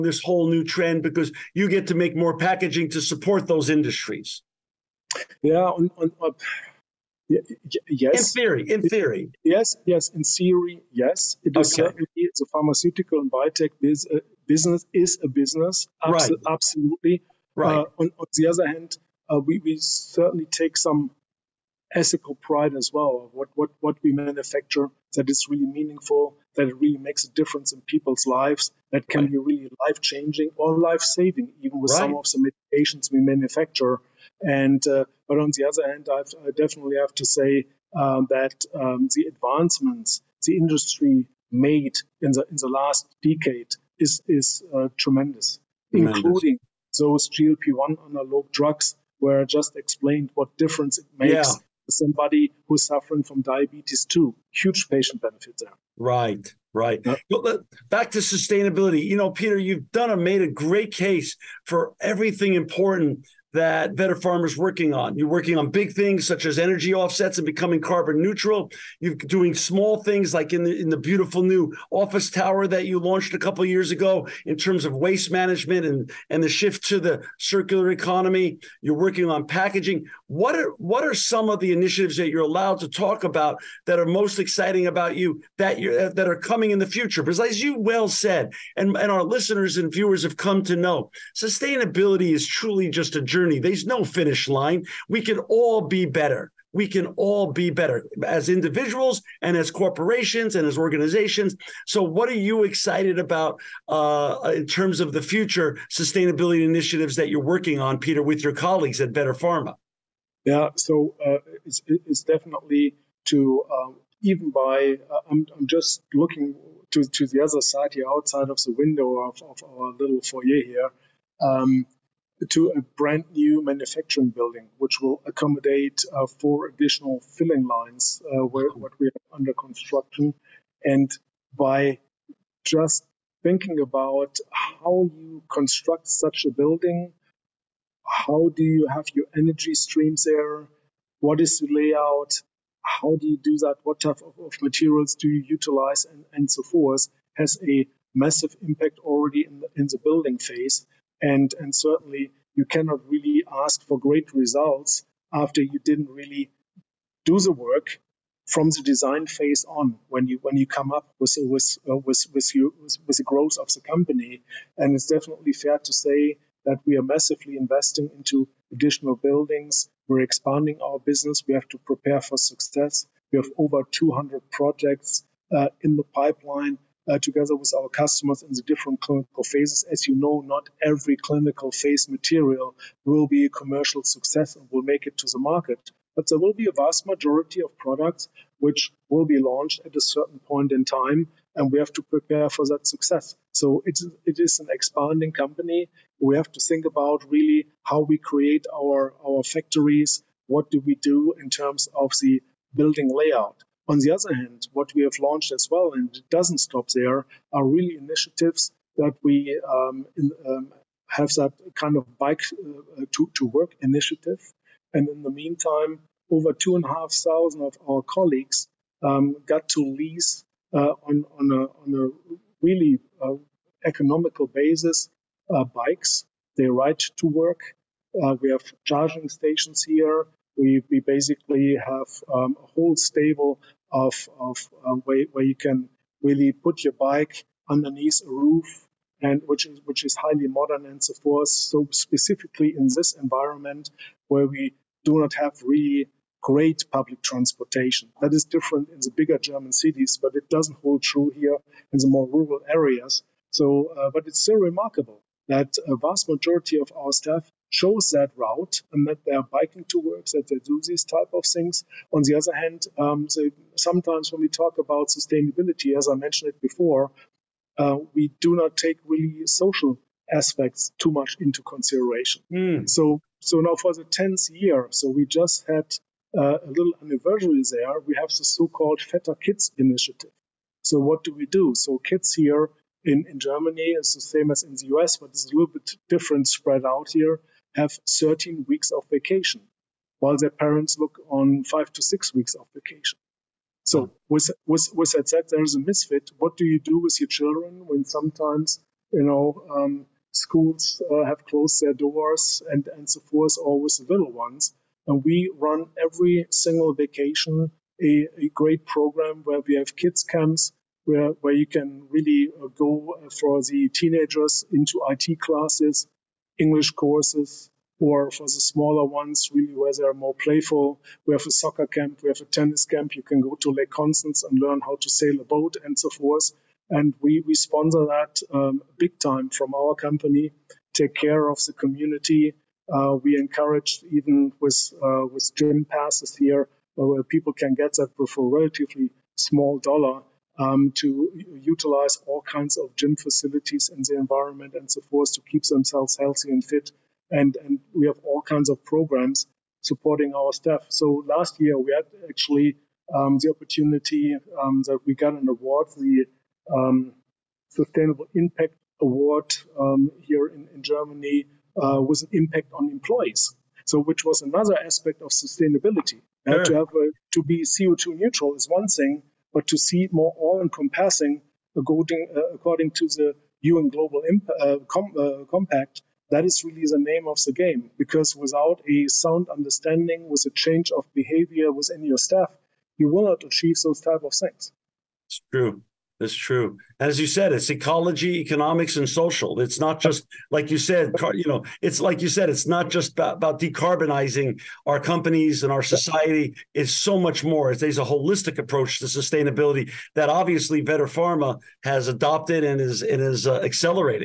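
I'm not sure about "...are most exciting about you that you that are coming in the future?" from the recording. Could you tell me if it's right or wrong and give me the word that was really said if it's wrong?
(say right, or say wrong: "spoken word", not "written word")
right.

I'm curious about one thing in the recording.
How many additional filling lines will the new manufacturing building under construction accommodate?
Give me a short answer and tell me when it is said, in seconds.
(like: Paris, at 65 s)
4, at 126 s.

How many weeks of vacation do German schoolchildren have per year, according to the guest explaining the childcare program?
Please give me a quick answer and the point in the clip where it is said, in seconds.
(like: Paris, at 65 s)
13 weeks, at 288 s.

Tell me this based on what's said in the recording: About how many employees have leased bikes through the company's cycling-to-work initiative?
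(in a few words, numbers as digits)
2,500.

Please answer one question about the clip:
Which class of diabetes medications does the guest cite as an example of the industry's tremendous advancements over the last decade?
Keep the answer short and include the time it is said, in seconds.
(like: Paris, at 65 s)
GLP-1 analog drugs, at 47 s.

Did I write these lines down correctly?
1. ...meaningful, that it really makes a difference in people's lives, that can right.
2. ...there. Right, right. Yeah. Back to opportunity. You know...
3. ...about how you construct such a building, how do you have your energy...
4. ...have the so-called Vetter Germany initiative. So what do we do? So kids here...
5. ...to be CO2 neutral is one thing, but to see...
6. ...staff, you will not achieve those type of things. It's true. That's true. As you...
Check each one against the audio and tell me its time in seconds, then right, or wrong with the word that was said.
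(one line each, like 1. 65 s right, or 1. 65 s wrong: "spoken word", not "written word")
1. 25 s right
2. 55 s wrong: "sustainability", not "opportunity"
3. 133 s right
4. 278 s wrong: "Kids", not "Germany"
5. 367 s right
6. 382 s right.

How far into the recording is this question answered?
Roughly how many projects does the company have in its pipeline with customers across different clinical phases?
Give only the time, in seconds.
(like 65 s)
173 s.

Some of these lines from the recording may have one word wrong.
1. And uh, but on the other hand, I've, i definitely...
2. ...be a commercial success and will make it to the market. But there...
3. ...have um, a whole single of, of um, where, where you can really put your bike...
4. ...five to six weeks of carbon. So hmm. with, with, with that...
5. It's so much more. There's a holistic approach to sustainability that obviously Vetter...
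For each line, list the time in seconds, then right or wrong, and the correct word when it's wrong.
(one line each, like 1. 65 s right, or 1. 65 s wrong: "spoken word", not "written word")
1. 34 s right
2. 183 s right
3. 231 s wrong: "stable", not "single"
4. 291 s wrong: "vacation", not "carbon"
5. 396 s right.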